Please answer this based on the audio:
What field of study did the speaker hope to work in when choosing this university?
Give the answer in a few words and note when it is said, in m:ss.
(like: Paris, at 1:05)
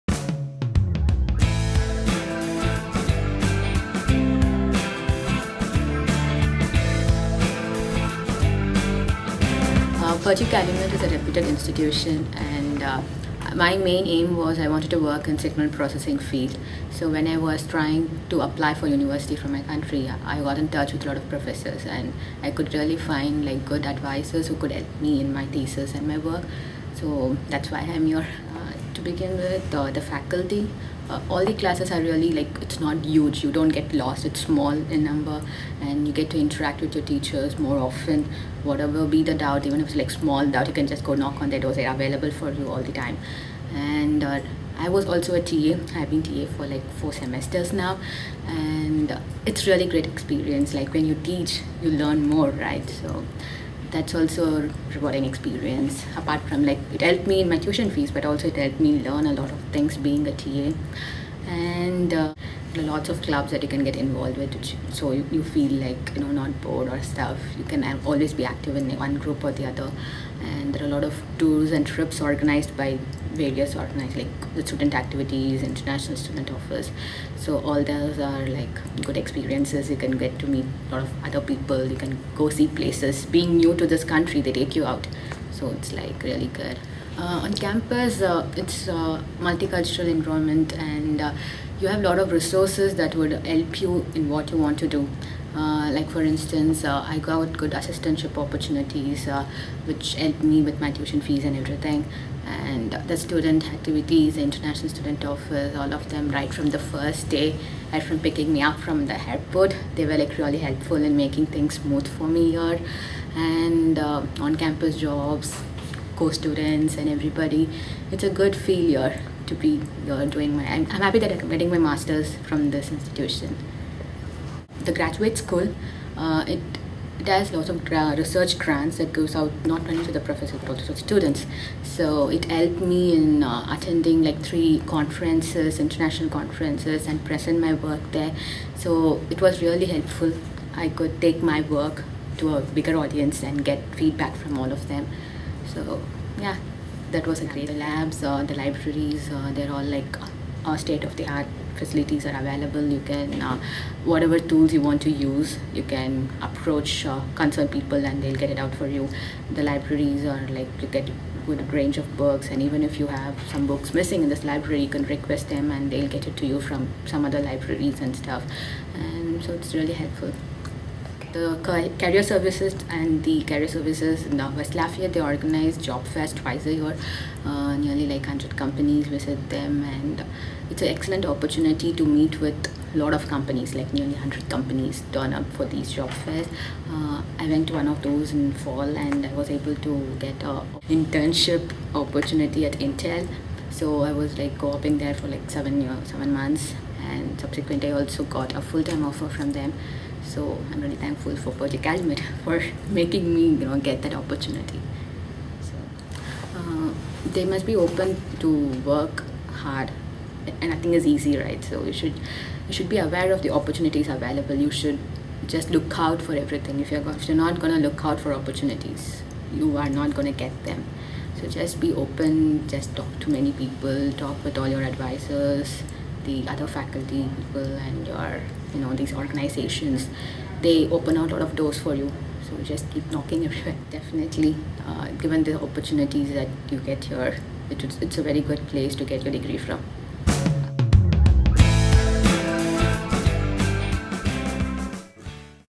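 signal processing, at 0:15.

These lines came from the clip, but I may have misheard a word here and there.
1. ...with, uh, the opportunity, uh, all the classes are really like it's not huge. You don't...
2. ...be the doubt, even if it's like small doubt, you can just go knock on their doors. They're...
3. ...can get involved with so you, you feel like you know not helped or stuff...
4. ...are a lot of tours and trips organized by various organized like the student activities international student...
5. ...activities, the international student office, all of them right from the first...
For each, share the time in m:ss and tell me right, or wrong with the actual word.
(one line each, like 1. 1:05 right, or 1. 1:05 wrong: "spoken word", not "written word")
1. 0:29 wrong: "faculty", not "opportunity"
2. 0:39 right
3. 1:03 wrong: "bored", not "helped"
4. 1:10 right
5. 1:43 right.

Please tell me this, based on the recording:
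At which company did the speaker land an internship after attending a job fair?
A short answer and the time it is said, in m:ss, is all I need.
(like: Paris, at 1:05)
Intel, at 3:12.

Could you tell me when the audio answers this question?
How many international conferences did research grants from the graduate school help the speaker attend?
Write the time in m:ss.
2:14.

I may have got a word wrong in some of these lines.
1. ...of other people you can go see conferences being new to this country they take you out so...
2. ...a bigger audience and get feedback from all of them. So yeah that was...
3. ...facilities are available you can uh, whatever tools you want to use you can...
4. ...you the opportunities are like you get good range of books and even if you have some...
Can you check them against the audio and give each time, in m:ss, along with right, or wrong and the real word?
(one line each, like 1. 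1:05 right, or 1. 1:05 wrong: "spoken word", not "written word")
1. 1:21 wrong: "places", not "conferences"
2. 2:22 right
3. 2:31 right
4. 2:38 wrong: "libraries", not "opportunities".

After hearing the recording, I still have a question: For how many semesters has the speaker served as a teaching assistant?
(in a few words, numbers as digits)
4.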